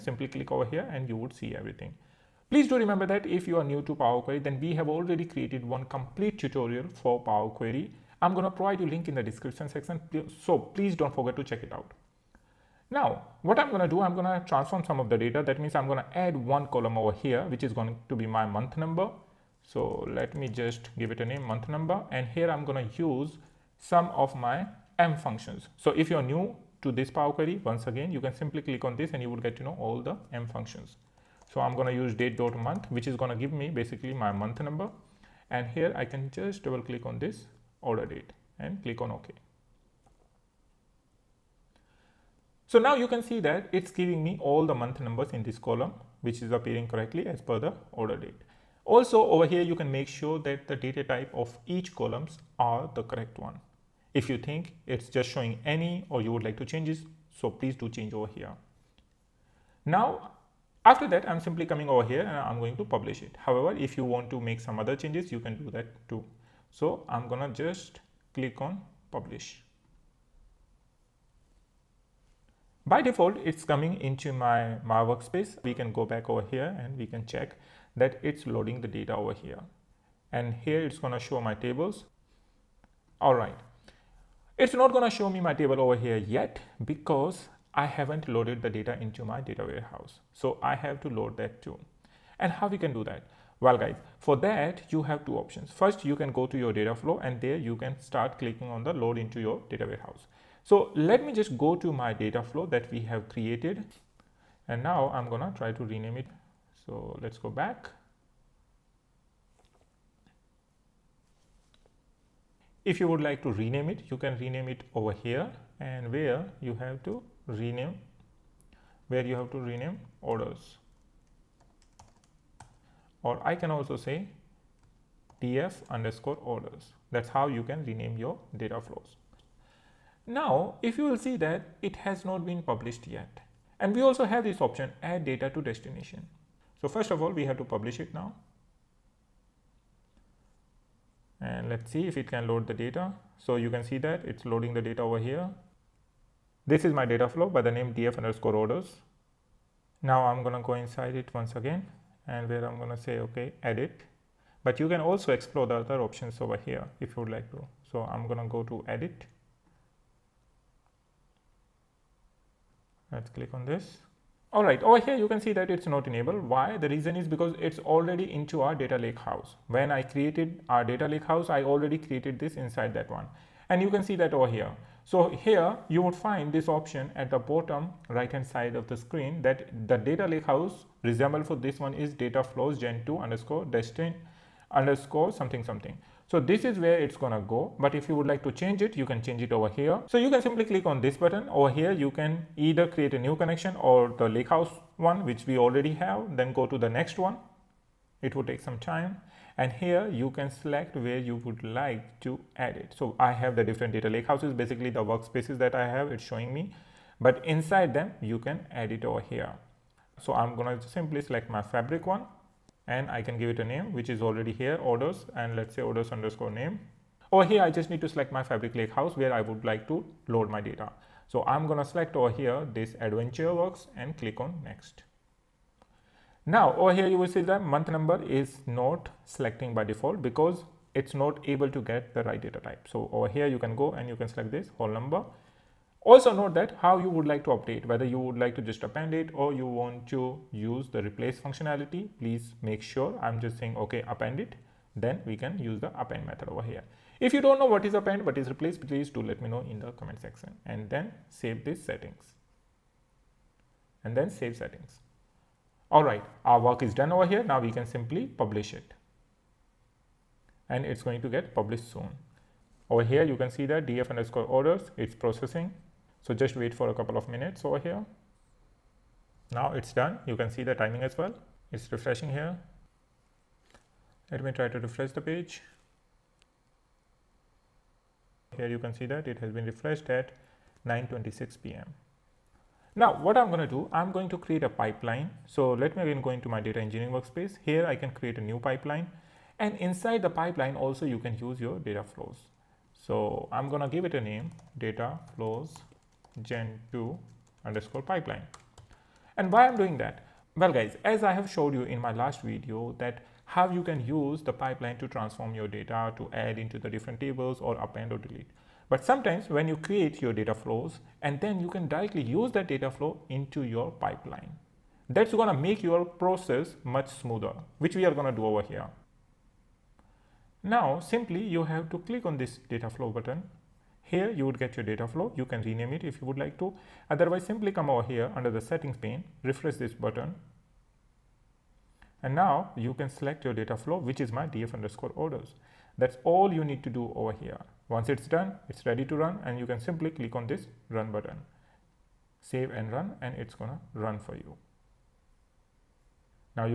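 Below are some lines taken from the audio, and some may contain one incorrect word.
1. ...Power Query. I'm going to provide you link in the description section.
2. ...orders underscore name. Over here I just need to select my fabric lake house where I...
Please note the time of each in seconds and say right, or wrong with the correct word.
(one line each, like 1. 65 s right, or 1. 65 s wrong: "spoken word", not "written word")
1. 7 s right
2. 215 s right.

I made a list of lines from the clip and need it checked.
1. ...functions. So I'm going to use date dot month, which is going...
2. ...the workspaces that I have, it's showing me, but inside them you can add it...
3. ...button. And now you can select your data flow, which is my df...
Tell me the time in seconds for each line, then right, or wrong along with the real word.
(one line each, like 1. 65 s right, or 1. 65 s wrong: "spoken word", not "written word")
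1. 30 s right
2. 204 s right
3. 329 s right.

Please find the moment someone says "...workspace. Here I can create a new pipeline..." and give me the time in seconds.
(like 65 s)
287 s.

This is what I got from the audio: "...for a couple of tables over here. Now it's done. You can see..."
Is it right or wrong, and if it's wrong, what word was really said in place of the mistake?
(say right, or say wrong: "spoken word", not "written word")
wrong: "minutes", not "tables".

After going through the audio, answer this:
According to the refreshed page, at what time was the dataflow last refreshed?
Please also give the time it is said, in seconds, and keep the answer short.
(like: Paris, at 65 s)
9:26 p.m., at 280 s.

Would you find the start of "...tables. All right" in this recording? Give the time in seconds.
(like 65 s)
81 s.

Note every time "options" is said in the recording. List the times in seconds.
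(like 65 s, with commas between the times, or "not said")
95 s, 134 s, 156 s, 176 s.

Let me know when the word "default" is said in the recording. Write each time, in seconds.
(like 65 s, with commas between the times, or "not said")
73 s, 229 s.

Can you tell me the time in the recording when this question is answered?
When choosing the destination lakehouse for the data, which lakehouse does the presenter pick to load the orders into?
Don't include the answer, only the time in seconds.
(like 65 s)
223 s.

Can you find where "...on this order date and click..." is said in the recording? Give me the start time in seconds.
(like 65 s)
37 s.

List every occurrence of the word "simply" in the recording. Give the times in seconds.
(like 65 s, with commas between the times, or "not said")
28 s, 61 s, 190 s, 210 s, 257 s, 321 s, 327 s, 339 s.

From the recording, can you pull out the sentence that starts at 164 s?
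All right, over here you can see that it's not enabled.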